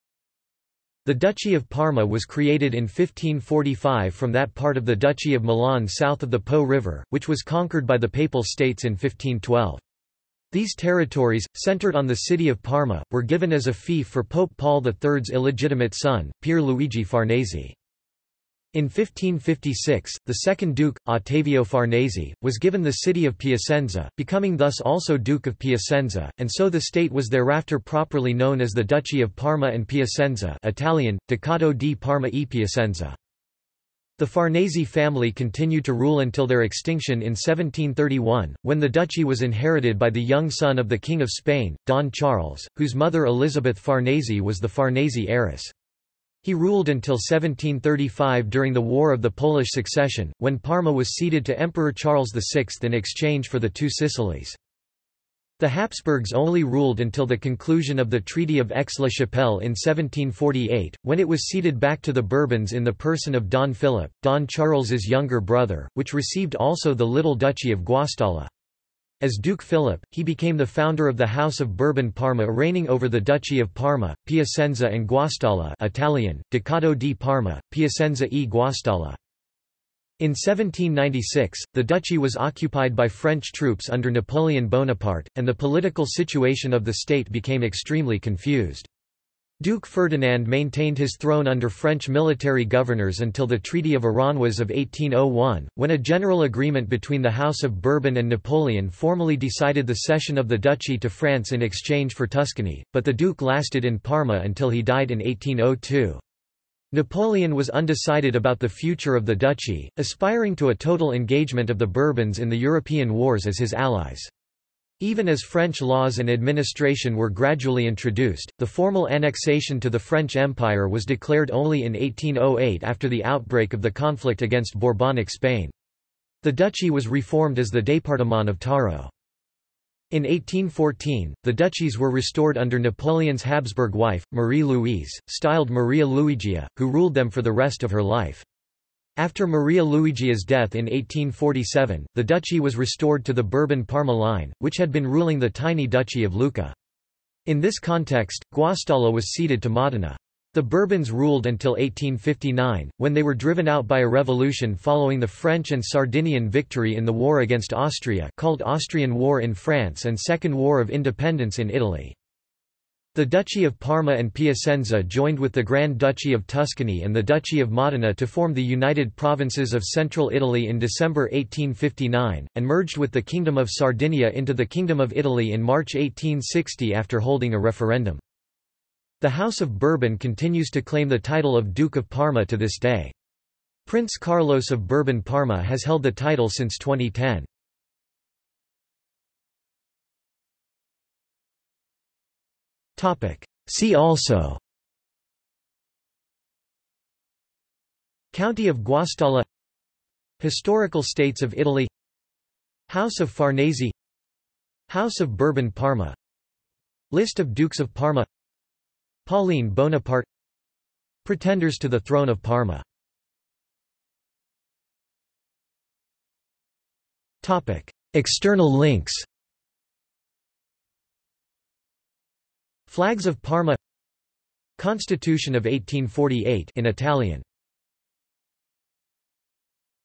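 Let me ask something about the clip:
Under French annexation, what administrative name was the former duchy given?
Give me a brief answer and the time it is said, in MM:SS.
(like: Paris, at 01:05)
Département of Taro, at 02:07.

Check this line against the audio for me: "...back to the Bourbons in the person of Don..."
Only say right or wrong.
right.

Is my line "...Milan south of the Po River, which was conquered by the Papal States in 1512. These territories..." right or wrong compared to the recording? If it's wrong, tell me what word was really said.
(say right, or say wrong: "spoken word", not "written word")
right.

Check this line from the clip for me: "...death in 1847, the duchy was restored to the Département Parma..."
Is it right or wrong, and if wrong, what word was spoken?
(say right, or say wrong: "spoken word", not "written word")
wrong: "Bourbon", not "Département".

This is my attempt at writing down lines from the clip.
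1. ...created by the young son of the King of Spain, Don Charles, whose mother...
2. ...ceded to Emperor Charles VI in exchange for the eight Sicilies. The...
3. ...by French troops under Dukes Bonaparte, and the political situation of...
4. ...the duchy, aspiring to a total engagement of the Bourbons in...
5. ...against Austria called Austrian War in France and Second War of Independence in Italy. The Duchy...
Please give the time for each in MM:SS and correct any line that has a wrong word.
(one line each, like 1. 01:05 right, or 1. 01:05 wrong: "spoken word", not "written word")
1. 00:39 wrong: "inherited", not "created"
2. 00:51 wrong: "two", not "eight"
3. 01:22 wrong: "Napoleon", not "Dukes"
4. 01:49 right
5. 02:37 right.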